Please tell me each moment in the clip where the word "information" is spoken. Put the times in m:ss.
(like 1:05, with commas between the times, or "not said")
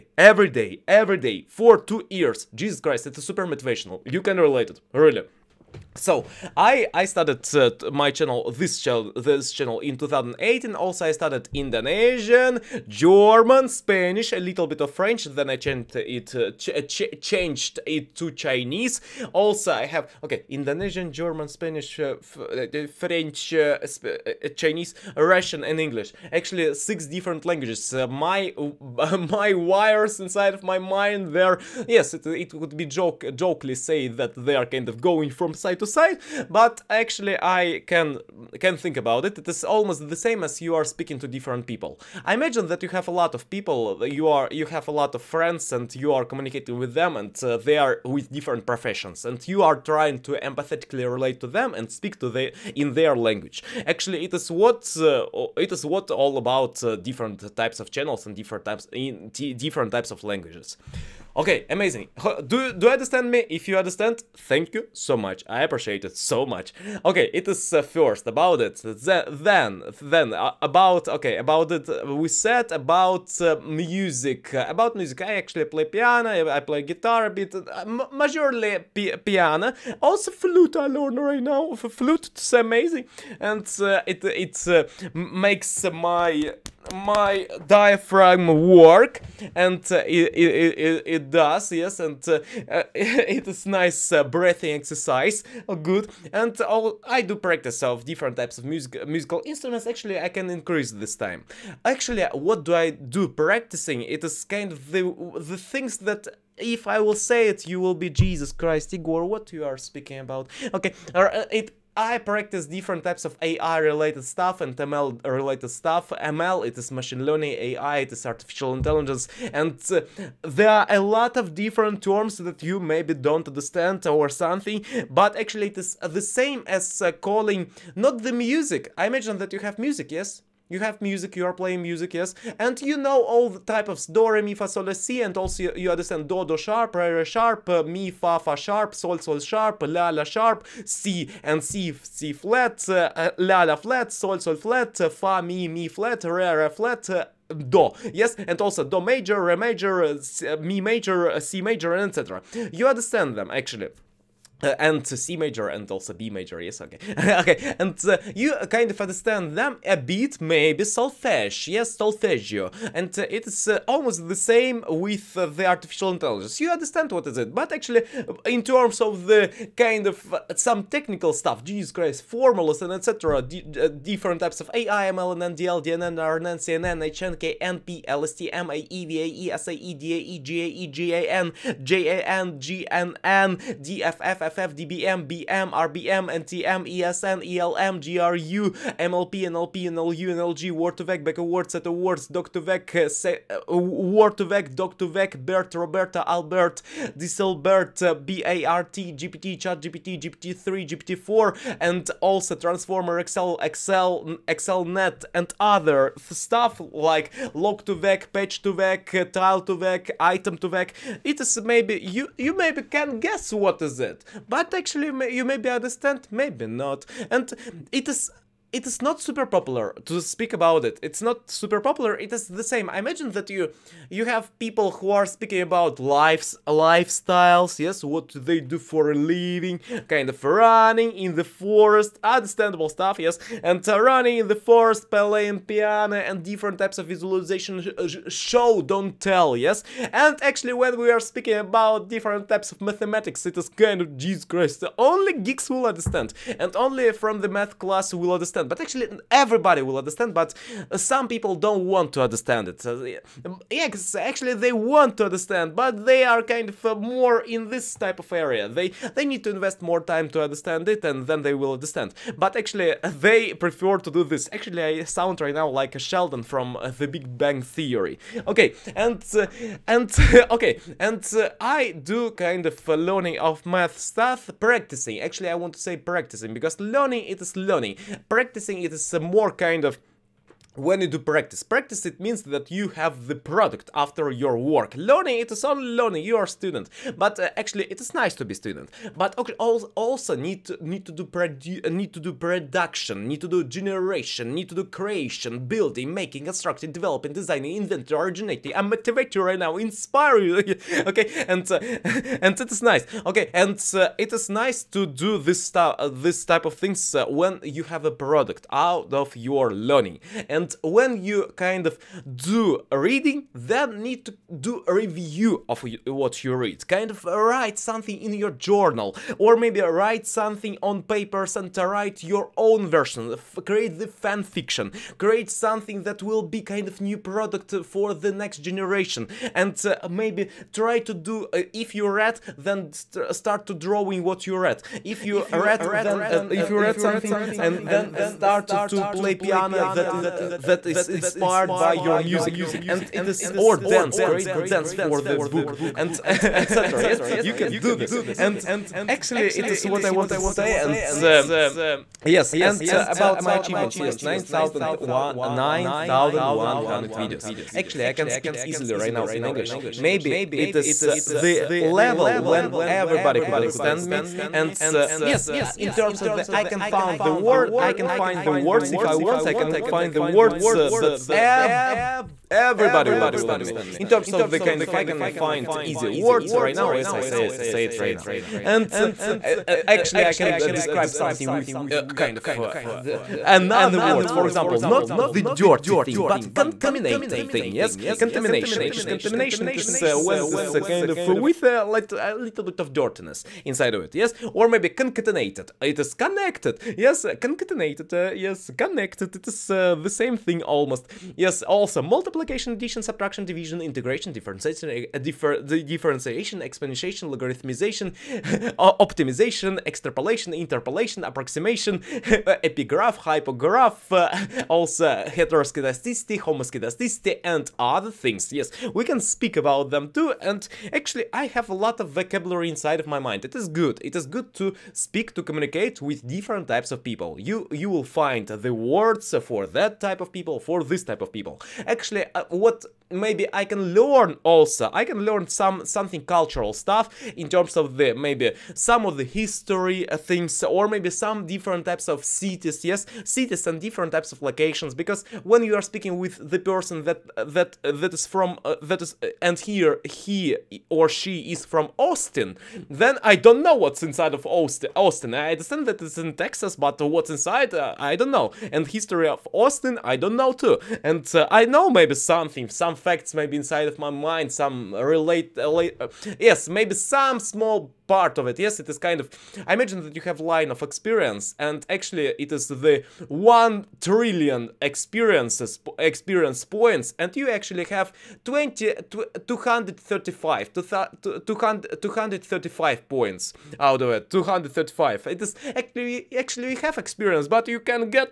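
not said.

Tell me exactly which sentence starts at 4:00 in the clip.
And actually, when we are speaking about different types of mathematics, it is kind of Jesus Christ.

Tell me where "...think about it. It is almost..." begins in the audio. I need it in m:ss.
0:38.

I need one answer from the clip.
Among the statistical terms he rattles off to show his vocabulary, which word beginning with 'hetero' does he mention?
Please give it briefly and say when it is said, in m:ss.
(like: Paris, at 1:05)
Heteroskedasticity, at 6:55.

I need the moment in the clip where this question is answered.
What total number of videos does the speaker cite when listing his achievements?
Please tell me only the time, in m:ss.
5:54.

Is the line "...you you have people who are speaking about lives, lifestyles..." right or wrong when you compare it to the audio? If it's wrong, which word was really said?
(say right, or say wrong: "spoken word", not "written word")
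right.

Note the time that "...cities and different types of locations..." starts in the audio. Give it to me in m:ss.
7:23.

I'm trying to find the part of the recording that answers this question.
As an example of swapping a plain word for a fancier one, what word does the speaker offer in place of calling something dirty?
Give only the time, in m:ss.
6:26.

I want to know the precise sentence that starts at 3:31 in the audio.
It is maybe, you, you maybe can guess what is it but actually you maybe understand, maybe not.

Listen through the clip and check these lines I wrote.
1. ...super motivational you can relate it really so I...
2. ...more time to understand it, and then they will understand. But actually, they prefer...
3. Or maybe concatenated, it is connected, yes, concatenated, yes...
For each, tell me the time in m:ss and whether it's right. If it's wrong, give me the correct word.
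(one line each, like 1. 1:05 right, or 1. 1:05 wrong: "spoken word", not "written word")
1. 0:03 right
2. 4:19 right
3. 6:34 right.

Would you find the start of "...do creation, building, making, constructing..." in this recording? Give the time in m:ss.
4:54.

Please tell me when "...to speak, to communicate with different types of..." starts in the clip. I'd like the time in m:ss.
7:04.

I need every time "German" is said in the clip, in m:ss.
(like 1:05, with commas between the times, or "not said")
0:12, 0:21.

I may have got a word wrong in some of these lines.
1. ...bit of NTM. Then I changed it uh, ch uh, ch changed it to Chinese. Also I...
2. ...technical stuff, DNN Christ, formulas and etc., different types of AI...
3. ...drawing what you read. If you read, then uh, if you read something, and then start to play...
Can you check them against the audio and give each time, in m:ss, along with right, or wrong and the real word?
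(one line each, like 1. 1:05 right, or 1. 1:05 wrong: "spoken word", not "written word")
1. 0:14 wrong: "French", not "NTM"
2. 2:50 wrong: "Jesus", not "DNN"
3. 5:33 right.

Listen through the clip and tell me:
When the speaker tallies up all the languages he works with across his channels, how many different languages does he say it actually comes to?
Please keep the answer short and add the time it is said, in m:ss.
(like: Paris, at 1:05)
6, at 0:26.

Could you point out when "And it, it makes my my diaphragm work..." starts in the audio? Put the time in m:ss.
1:23.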